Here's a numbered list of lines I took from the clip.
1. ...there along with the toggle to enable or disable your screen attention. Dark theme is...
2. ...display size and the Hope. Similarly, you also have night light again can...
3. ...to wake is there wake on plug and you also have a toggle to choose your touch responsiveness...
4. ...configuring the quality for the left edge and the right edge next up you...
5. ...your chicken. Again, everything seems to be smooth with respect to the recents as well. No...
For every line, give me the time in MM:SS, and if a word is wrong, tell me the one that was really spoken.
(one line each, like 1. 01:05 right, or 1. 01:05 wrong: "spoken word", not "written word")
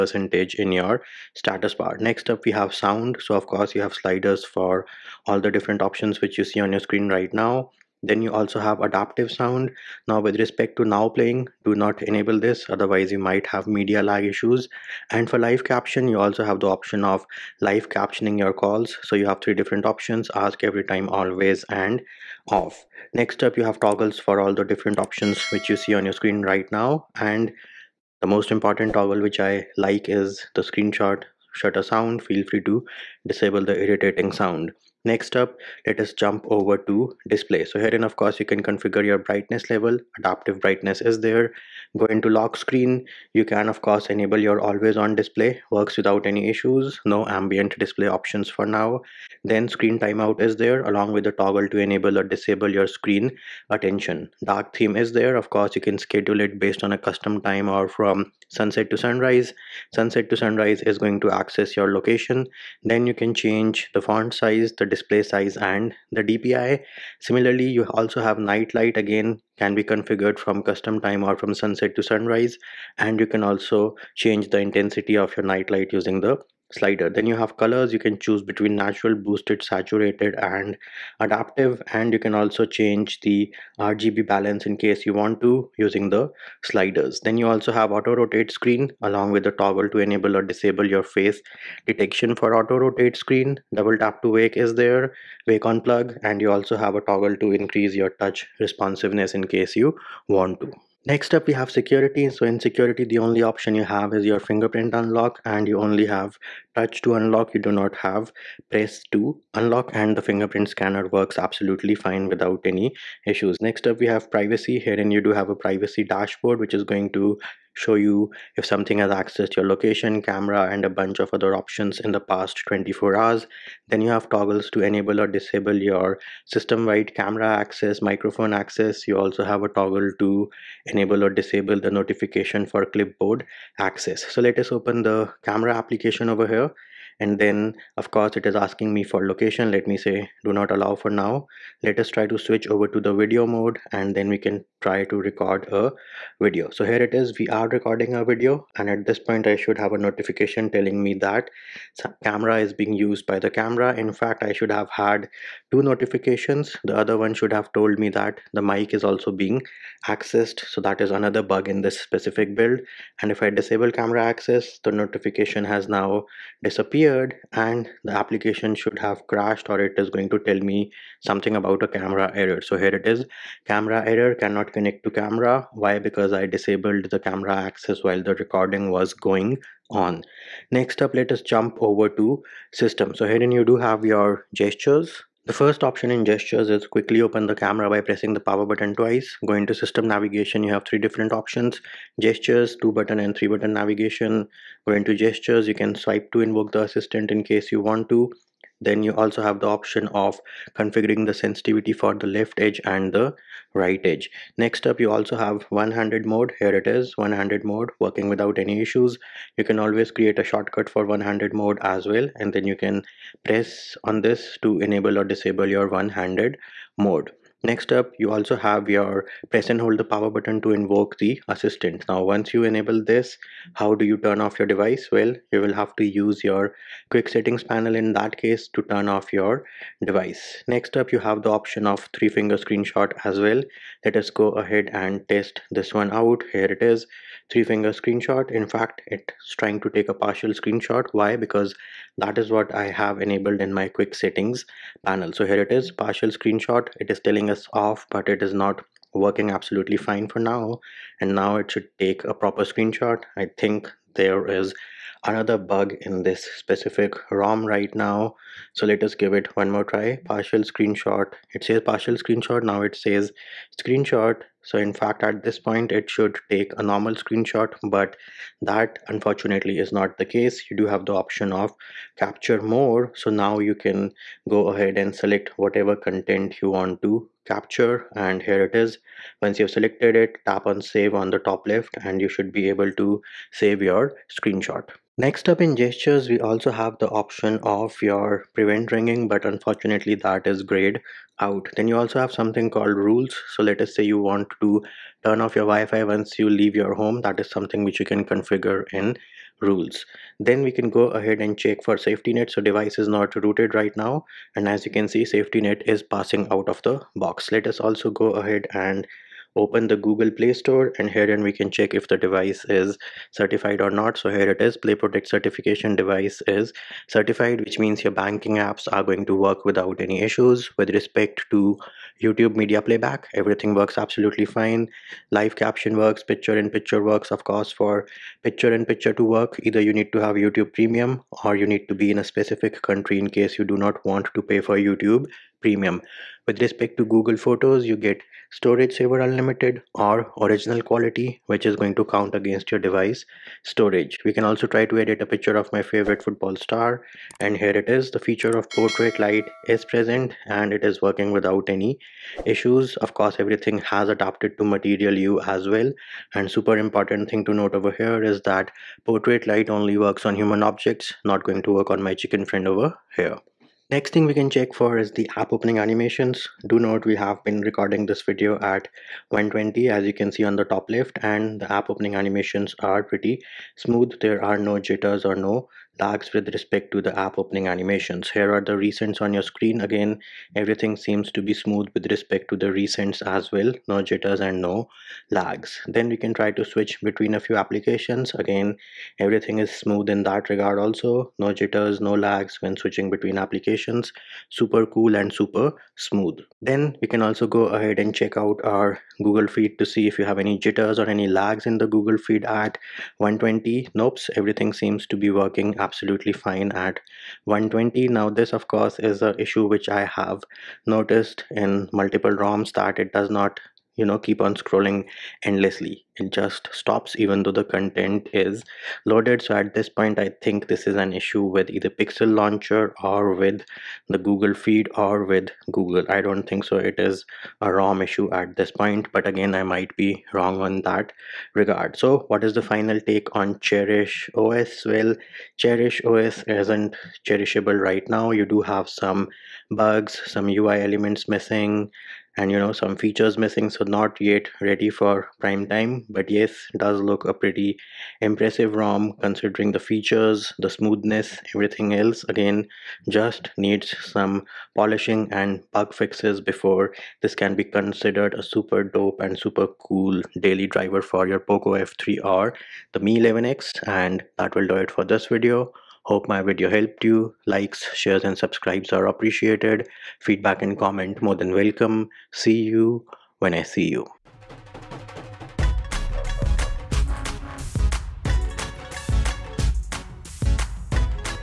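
1. 00:50 right
2. 01:04 wrong: "DPI", not "Hope"
3. 01:34 wrong: "increase", not "choose"
4. 03:20 wrong: "sensitivity", not "quality"
5. 06:19 wrong: "screen", not "chicken".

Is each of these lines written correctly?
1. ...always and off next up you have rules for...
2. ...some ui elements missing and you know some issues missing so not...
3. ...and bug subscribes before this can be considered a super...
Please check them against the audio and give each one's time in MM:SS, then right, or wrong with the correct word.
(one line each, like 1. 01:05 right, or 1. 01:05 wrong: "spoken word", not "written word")
1. 00:21 wrong: "toggles", not "rules"
2. 07:20 wrong: "features", not "issues"
3. 07:35 wrong: "fixes", not "subscribes".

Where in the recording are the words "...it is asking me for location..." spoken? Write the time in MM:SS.
02:18.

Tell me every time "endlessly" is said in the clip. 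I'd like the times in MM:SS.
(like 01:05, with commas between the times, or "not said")
06:55.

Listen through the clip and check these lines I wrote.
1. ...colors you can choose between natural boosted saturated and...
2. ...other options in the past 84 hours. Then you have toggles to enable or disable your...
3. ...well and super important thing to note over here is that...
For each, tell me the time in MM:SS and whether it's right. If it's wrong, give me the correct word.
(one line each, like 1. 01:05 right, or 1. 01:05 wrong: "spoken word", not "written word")
1. 01:17 right
2. 02:01 wrong: "24", not "84"
3. 05:55 right.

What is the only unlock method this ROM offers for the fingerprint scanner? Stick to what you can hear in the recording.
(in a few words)
Touch to unlock.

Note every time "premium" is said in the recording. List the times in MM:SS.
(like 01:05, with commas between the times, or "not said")
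05:30, 05:35.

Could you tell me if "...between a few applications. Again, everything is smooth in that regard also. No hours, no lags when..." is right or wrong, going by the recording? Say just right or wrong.
wrong.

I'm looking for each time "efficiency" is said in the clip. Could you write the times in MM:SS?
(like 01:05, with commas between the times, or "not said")
not said.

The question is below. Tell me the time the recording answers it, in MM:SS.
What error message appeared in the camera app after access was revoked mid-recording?
02:54.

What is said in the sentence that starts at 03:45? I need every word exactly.
Well, you will have to use your quick settings panel in that case to turn off your device.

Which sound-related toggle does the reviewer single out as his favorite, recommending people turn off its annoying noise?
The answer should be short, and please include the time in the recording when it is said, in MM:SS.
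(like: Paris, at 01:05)
Screenshot shutter sound, at 00:30.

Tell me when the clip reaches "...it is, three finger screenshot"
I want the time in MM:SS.
03:56.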